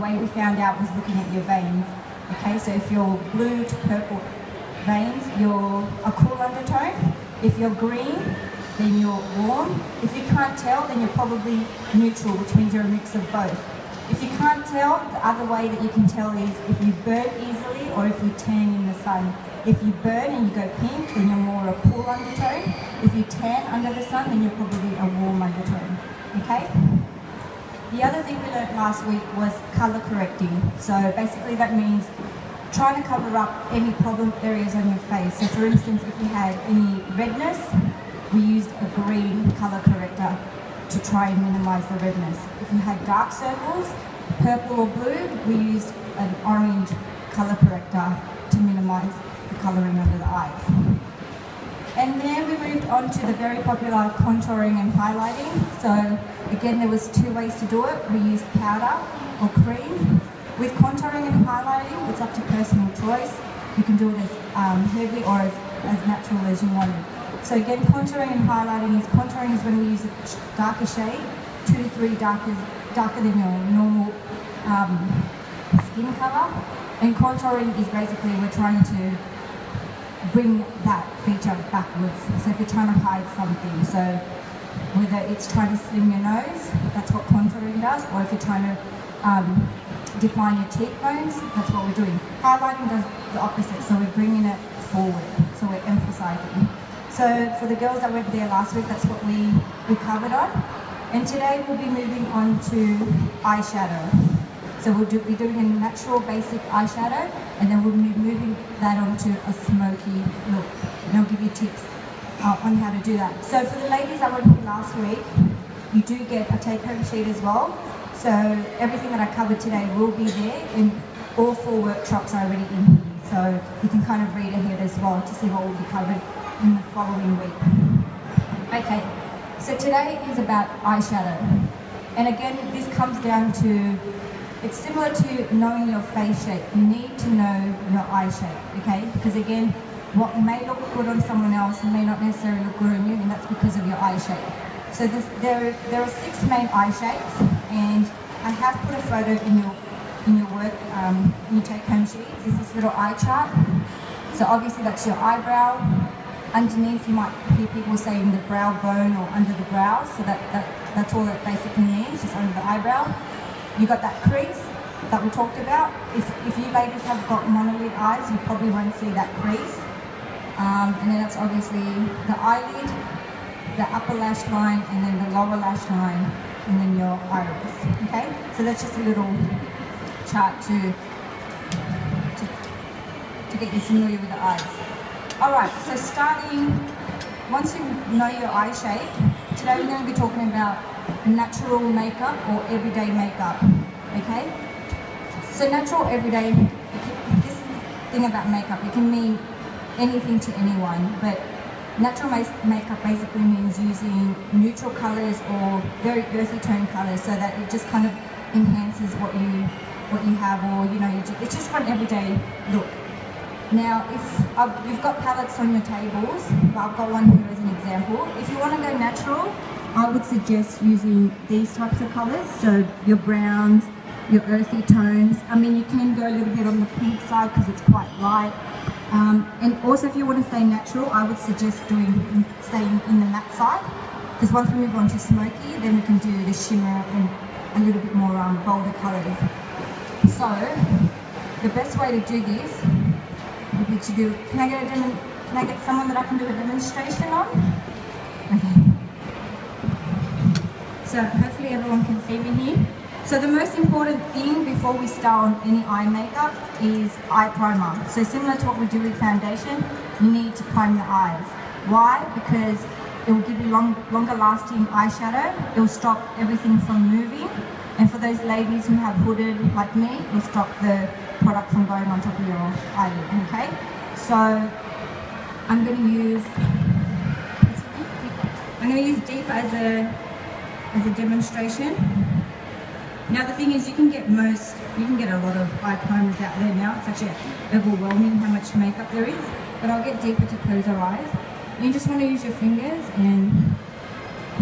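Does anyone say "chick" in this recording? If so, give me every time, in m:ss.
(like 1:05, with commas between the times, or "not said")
not said.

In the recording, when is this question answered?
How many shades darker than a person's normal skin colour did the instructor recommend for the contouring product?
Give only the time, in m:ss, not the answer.
1:11.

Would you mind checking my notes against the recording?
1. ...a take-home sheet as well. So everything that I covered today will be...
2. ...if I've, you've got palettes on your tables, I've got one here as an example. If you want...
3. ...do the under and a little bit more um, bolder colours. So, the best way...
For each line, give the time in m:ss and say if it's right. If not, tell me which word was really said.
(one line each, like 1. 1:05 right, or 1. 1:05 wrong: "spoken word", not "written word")
1. 1:56 right
2. 3:34 right
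3. 3:56 wrong: "shimmer", not "under".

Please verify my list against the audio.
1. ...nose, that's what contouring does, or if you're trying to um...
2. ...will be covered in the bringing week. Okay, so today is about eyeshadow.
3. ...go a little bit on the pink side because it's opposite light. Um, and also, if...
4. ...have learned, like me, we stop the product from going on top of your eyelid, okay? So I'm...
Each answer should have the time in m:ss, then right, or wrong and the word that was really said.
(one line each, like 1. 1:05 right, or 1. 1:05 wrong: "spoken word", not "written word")
1. 1:26 right
2. 2:05 wrong: "following", not "bringing"
3. 3:46 wrong: "quite", not "opposite"
4. 4:28 wrong: "hooded", not "learned".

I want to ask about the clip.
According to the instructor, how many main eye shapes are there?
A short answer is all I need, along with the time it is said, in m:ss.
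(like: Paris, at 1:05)
6, at 2:26.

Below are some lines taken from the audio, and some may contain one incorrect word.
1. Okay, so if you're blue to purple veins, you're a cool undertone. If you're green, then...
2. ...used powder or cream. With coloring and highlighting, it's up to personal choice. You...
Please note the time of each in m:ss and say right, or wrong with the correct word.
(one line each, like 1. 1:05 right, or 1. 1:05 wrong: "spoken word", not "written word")
1. 0:02 right
2. 0:58 wrong: "contouring", not "coloring".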